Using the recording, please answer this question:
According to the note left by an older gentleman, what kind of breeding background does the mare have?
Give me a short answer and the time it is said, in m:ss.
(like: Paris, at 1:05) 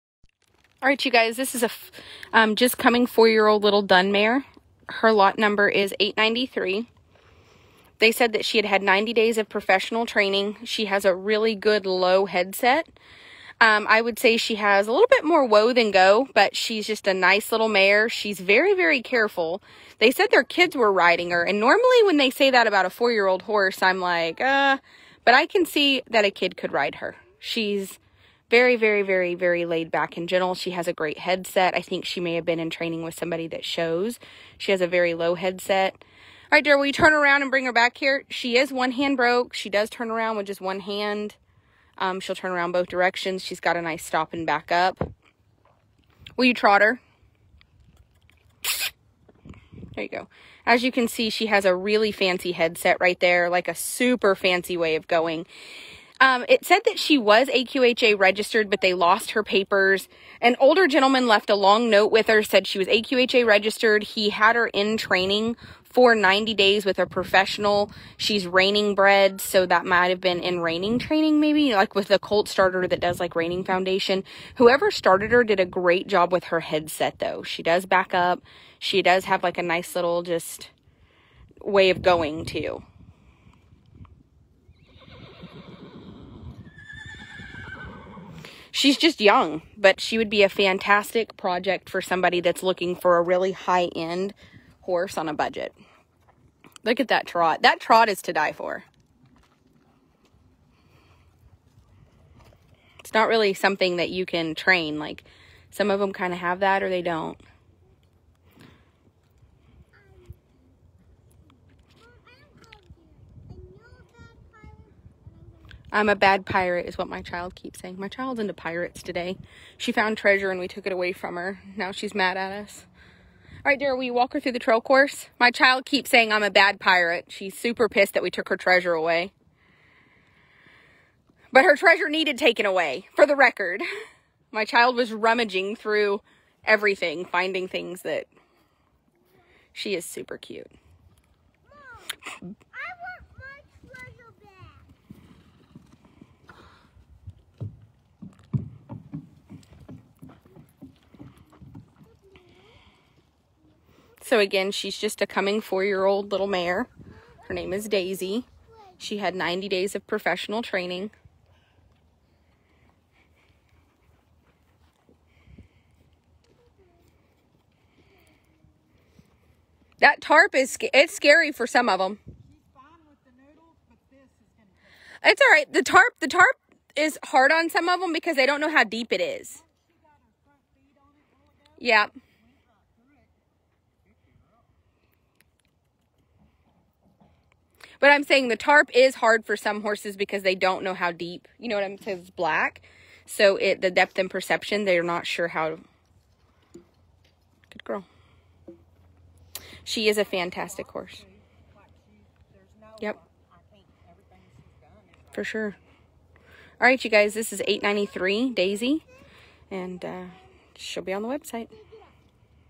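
Reining bred, at 1:08.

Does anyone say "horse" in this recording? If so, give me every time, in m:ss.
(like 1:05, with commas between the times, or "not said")
0:23, 1:34, 3:09, 3:20.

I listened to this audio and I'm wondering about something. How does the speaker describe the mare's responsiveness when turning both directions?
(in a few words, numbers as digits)
One hand broke.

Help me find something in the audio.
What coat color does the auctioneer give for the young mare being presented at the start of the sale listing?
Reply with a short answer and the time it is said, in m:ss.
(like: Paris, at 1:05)
Dun, at 0:03.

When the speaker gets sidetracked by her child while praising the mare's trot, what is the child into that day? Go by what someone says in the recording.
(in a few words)
Pirates.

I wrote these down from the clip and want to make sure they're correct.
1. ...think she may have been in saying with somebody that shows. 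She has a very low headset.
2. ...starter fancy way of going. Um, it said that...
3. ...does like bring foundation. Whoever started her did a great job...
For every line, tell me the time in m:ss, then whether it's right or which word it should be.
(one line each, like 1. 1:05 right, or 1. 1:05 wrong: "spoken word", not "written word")
1. 0:31 wrong: "training", not "saying"
2. 0:53 wrong: "super", not "starter"
3. 1:12 wrong: "reining", not "bring".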